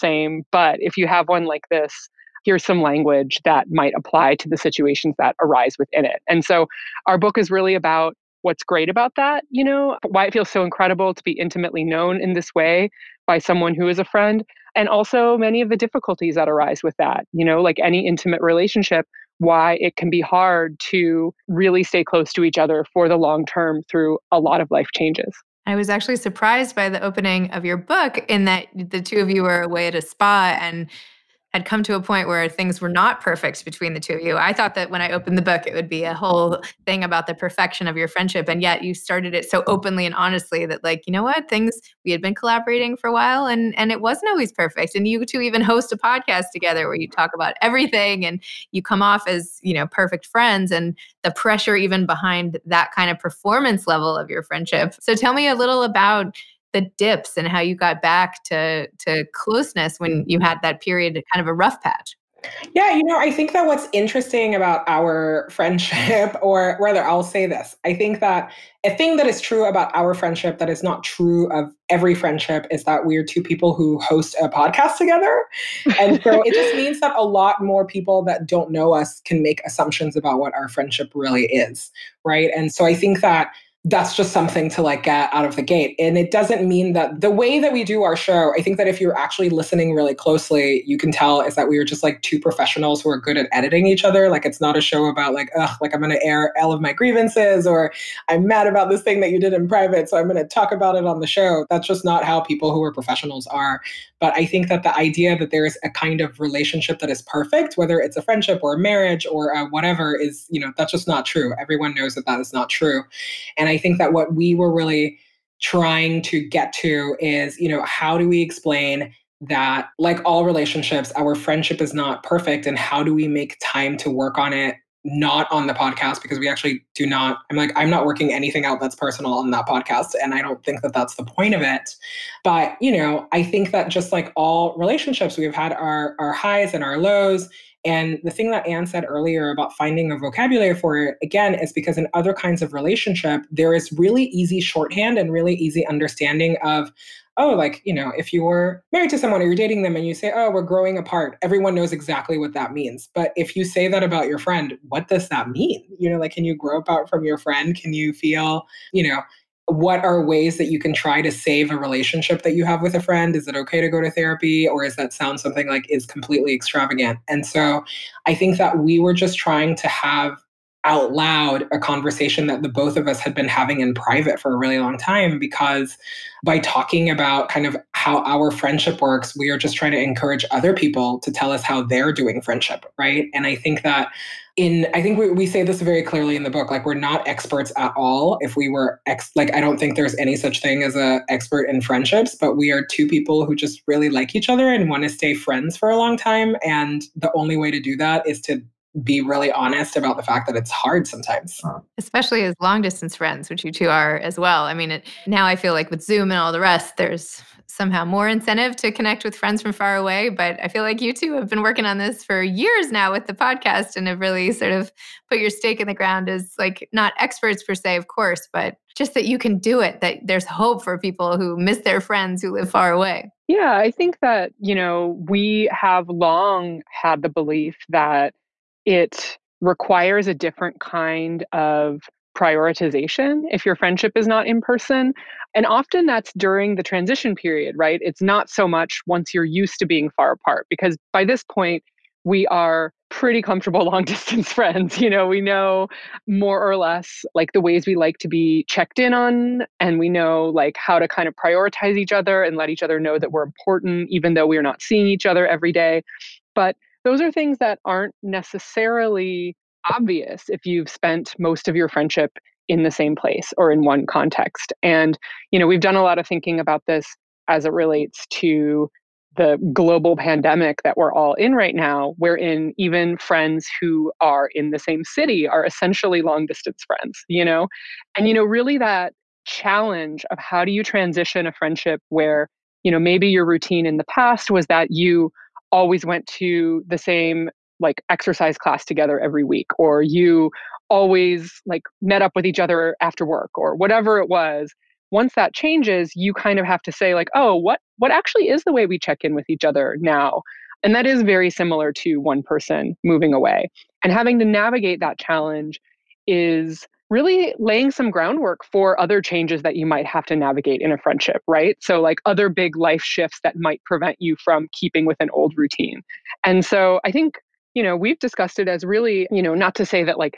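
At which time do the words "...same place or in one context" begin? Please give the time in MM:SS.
04:22.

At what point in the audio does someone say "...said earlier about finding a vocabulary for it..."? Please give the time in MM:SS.
02:18.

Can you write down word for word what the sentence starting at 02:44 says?
Or is that sound something like is completely extravagant?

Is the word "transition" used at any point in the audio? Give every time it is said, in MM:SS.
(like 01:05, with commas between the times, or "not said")
03:56, 04:40.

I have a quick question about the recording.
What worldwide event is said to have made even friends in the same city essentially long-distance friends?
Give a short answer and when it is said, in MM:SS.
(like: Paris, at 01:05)
global pandemic, at 04:29.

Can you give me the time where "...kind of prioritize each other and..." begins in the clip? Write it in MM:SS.
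04:11.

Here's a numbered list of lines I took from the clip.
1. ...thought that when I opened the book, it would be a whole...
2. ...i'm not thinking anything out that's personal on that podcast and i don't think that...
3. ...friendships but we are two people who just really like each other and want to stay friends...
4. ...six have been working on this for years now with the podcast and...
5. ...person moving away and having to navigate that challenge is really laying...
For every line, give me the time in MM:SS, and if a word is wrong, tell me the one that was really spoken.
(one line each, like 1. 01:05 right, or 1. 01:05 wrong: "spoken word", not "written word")
1. 00:34 right
2. 02:07 wrong: "working", not "thinking"
3. 03:11 right
4. 03:31 wrong: "two", not "six"
5. 05:02 right.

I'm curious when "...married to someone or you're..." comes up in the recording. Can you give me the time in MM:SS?
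02:28.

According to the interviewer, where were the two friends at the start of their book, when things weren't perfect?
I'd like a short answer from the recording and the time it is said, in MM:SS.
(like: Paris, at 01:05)
a spa, at 00:29.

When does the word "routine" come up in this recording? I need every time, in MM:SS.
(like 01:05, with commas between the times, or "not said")
04:43, 05:15.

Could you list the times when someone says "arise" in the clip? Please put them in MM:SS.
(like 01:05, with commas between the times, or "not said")
00:05, 00:16.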